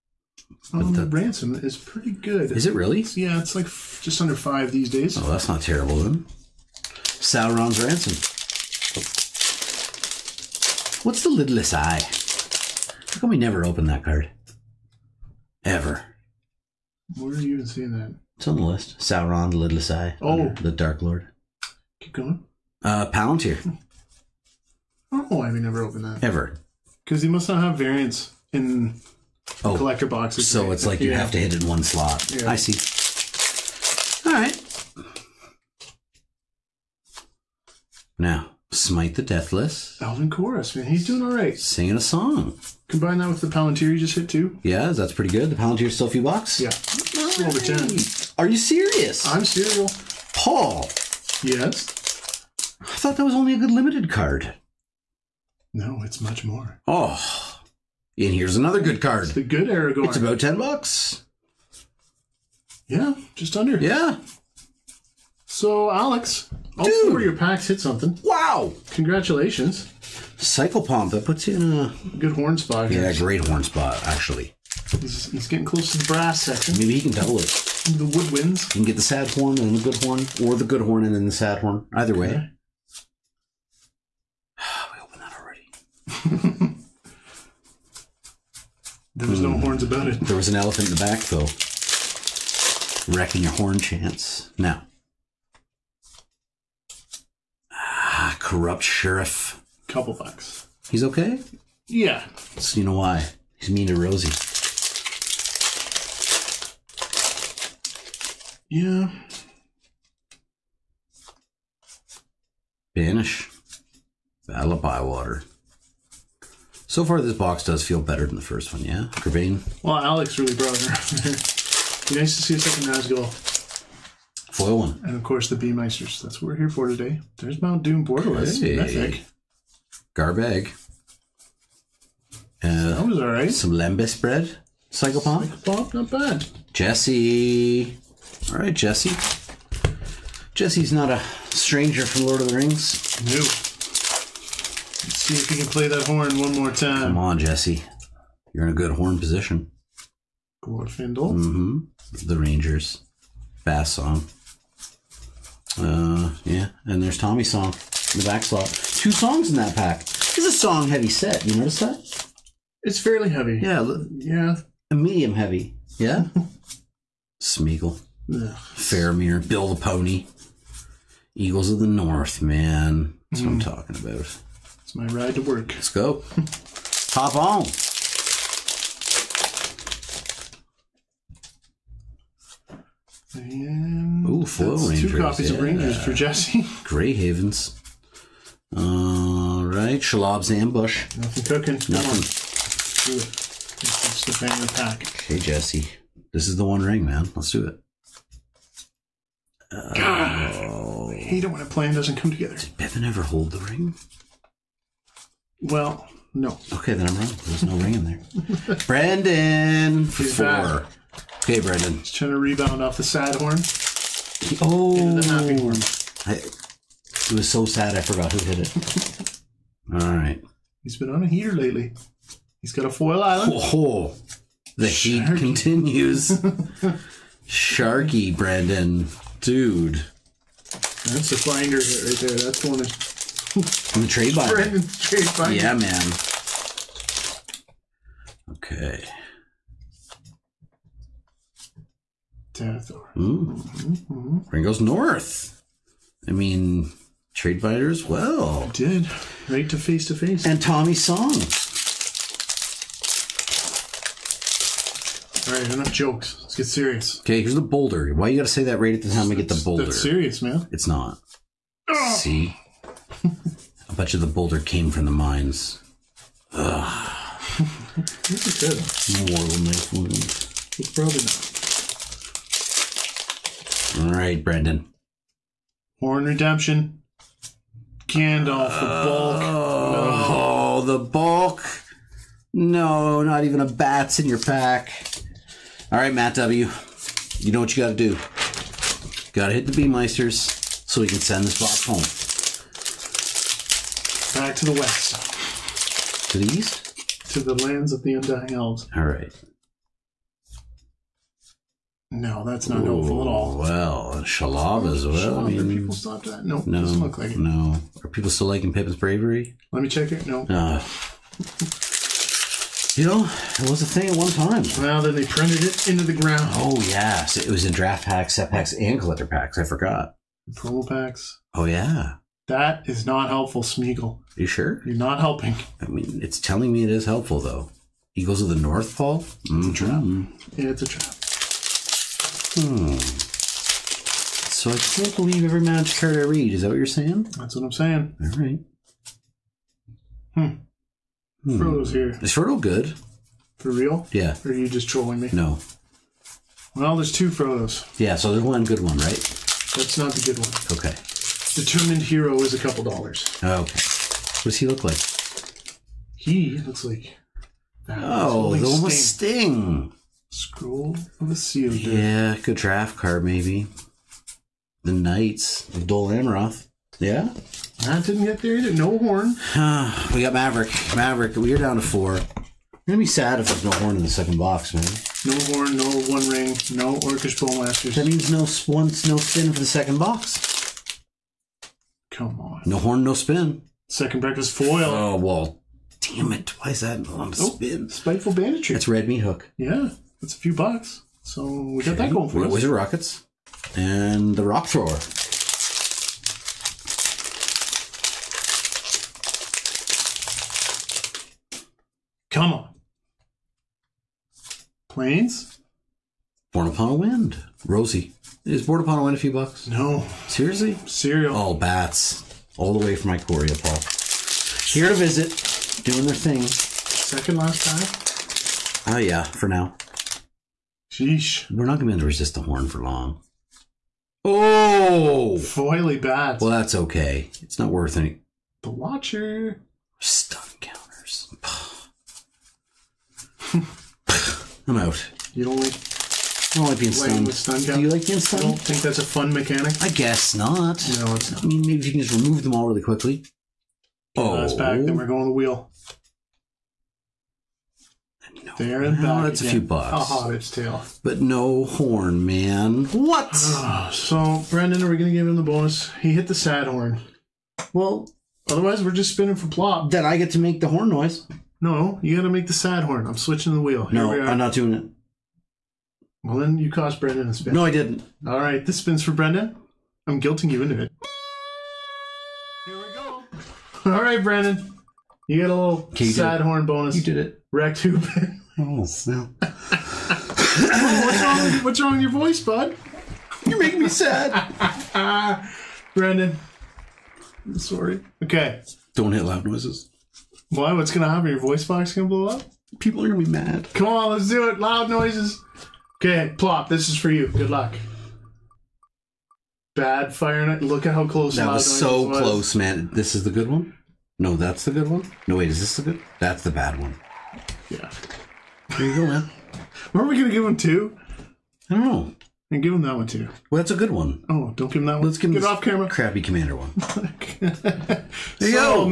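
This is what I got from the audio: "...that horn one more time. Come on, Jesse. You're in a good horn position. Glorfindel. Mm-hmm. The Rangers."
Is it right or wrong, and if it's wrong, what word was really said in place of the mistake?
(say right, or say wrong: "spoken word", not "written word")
right.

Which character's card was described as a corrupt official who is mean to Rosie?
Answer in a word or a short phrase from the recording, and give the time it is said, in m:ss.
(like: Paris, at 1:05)
Corrupt sheriff, at 1:38.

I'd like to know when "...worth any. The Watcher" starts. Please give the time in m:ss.
7:07.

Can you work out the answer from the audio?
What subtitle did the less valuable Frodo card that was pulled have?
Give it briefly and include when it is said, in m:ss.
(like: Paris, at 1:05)
Determined Hero, at 5:51.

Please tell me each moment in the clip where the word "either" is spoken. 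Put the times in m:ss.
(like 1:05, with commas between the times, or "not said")
1:21, 6:08.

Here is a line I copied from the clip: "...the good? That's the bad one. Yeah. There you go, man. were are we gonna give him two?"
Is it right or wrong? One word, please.
right.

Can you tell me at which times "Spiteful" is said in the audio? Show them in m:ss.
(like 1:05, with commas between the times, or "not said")
6:27.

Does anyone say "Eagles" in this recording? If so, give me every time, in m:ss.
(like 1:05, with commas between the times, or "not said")
2:51, 5:28.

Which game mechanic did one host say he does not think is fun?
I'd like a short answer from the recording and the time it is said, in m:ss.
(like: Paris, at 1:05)
stun, at 7:17.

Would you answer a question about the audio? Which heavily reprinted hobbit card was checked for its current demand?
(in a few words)
Pippin's bravery.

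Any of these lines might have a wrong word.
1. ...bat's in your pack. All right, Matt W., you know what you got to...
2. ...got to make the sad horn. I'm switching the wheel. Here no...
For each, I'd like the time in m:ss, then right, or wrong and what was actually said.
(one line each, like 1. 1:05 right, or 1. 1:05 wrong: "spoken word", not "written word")
1. 4:43 right
2. 7:42 right.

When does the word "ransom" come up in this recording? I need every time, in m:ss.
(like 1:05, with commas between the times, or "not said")
0:01, 0:07.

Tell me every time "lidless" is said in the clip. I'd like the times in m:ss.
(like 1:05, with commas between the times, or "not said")
0:11, 0:19.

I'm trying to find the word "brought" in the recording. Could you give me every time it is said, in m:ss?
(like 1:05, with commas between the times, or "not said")
2:00.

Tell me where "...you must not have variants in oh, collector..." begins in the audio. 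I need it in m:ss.
0:27.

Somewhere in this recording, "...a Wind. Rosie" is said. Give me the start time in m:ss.
6:46.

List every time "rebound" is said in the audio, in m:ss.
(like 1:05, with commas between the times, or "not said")
3:32.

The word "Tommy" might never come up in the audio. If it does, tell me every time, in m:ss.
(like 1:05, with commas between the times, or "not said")
2:37, 4:10.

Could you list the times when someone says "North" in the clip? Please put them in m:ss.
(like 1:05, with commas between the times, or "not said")
2:51, 4:04, 5:28.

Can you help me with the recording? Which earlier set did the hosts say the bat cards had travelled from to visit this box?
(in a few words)
Ikoria.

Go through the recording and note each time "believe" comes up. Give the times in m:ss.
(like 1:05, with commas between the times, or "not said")
5:35.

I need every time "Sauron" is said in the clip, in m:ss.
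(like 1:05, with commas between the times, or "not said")
0:07, 0:18.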